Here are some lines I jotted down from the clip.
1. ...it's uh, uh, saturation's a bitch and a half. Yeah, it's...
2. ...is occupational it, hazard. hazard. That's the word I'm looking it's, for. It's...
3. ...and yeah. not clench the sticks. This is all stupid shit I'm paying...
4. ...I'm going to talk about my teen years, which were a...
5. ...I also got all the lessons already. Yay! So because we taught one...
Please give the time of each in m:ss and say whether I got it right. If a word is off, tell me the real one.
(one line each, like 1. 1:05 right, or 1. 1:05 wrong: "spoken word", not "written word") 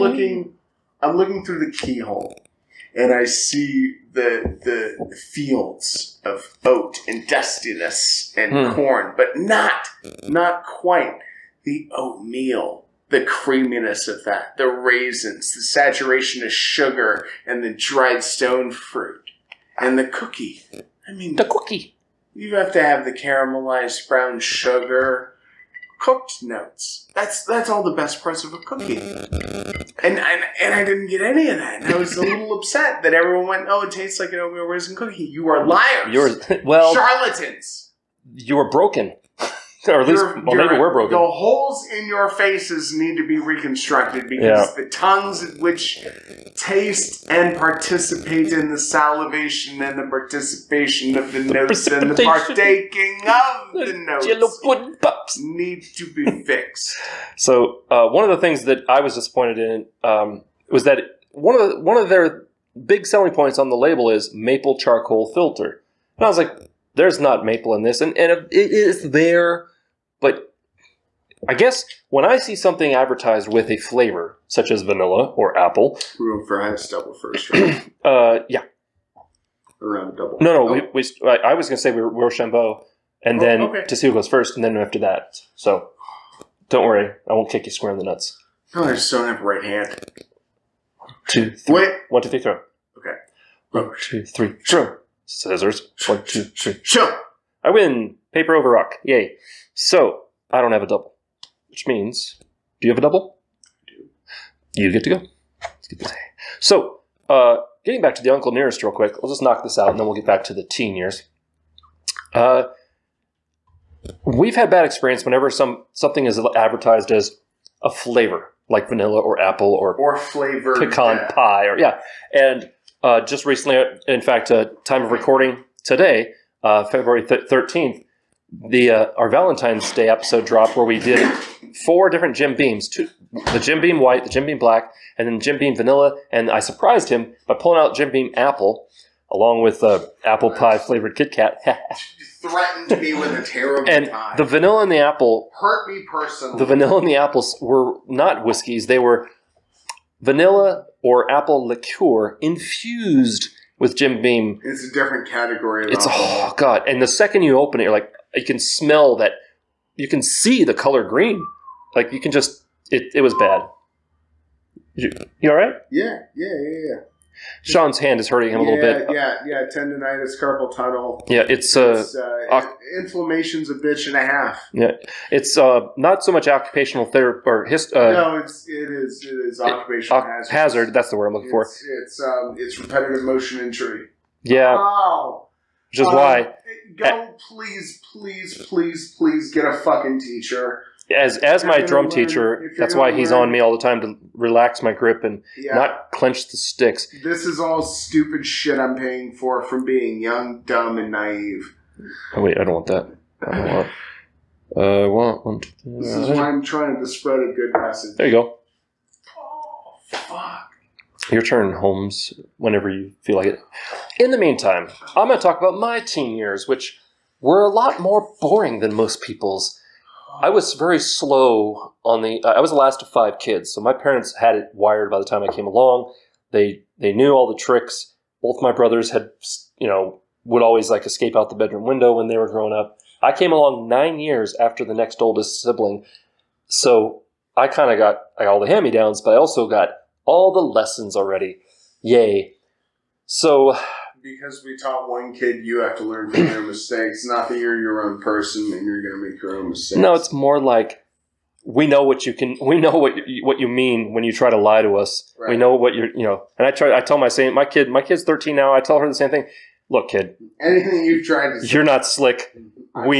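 1. 2:51 wrong: "inflammation", not "saturation"
2. 2:59 right
3. 3:15 right
4. 3:35 right
5. 3:59 right.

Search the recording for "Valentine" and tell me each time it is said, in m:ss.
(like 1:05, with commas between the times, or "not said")
2:09.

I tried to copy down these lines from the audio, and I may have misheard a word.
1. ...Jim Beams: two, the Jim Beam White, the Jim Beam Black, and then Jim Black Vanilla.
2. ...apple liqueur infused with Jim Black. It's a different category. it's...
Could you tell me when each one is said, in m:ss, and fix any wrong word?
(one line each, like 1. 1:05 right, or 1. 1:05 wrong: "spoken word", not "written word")
1. 2:12 wrong: "Beam", not "Black"
2. 2:31 wrong: "Beam", not "Black".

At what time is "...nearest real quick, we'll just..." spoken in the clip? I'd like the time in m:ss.
1:48.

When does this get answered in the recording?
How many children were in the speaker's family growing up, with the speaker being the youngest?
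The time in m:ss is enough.
3:43.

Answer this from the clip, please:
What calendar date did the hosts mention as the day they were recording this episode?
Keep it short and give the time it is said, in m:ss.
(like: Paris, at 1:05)
February 13, at 2:06.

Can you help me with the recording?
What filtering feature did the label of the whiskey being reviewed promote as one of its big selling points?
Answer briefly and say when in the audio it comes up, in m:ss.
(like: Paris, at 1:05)
Maple charcoal filter, at 1:04.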